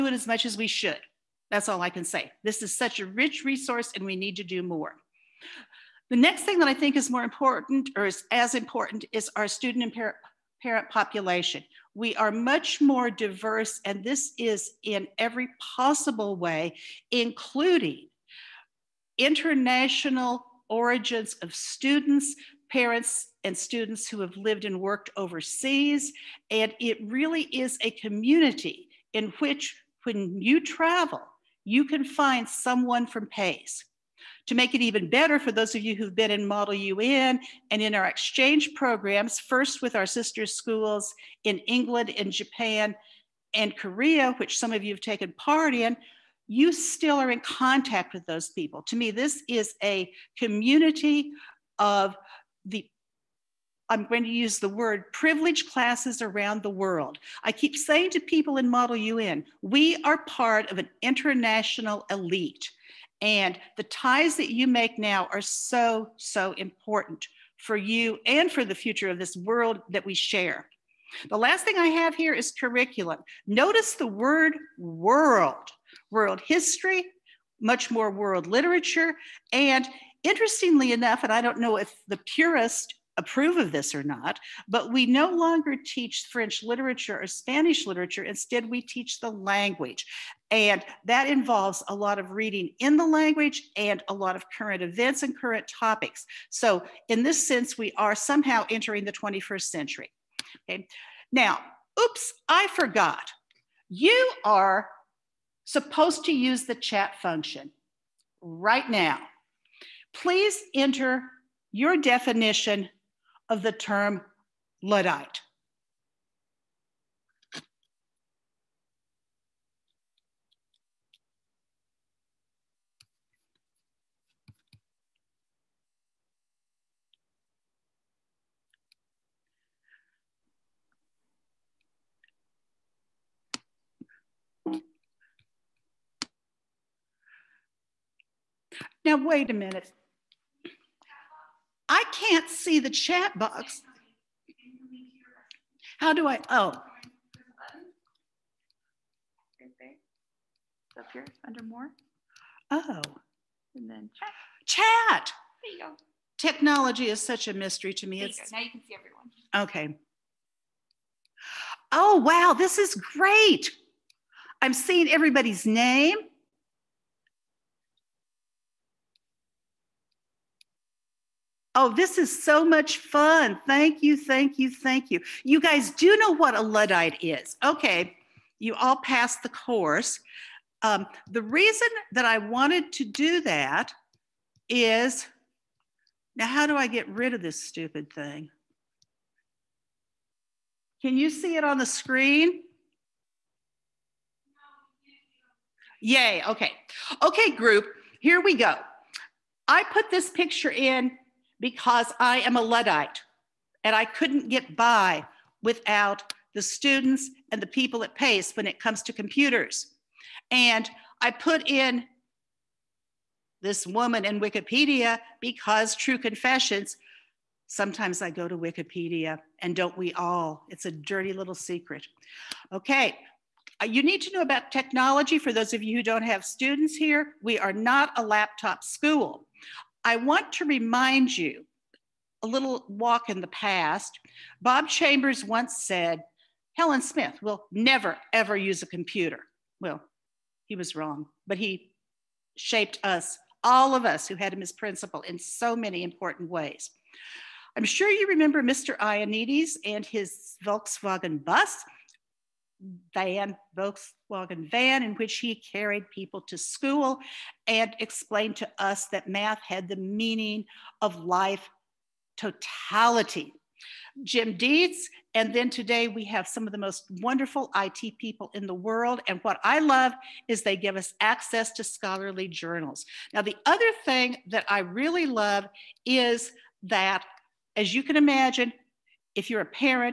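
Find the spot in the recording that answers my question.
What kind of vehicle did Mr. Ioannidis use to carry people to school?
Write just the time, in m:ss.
4:13.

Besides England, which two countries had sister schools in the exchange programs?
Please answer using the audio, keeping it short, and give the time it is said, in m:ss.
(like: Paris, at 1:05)
Japan and Korea, at 0:42.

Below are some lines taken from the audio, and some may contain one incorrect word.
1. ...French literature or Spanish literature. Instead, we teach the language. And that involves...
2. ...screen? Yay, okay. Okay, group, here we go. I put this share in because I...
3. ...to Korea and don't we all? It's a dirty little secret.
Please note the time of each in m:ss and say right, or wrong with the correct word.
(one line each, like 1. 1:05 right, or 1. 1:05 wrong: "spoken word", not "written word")
1. 1:26 right
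2. 3:11 wrong: "picture", not "share"
3. 3:38 wrong: "Wikipedia", not "Korea".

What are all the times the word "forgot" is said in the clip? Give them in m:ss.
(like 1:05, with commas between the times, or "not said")
1:42.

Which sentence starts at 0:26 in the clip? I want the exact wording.
And it really is a community in which when you travel, you can find someone from PACE.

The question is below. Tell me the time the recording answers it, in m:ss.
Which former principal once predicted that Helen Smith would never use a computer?
3:54.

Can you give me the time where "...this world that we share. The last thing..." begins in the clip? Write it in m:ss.
1:09.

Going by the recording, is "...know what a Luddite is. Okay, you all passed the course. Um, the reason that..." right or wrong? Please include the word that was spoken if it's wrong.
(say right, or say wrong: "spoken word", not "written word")
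right.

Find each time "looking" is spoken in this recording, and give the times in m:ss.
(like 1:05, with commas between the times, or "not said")
not said.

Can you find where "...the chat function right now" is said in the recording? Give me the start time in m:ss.
1:46.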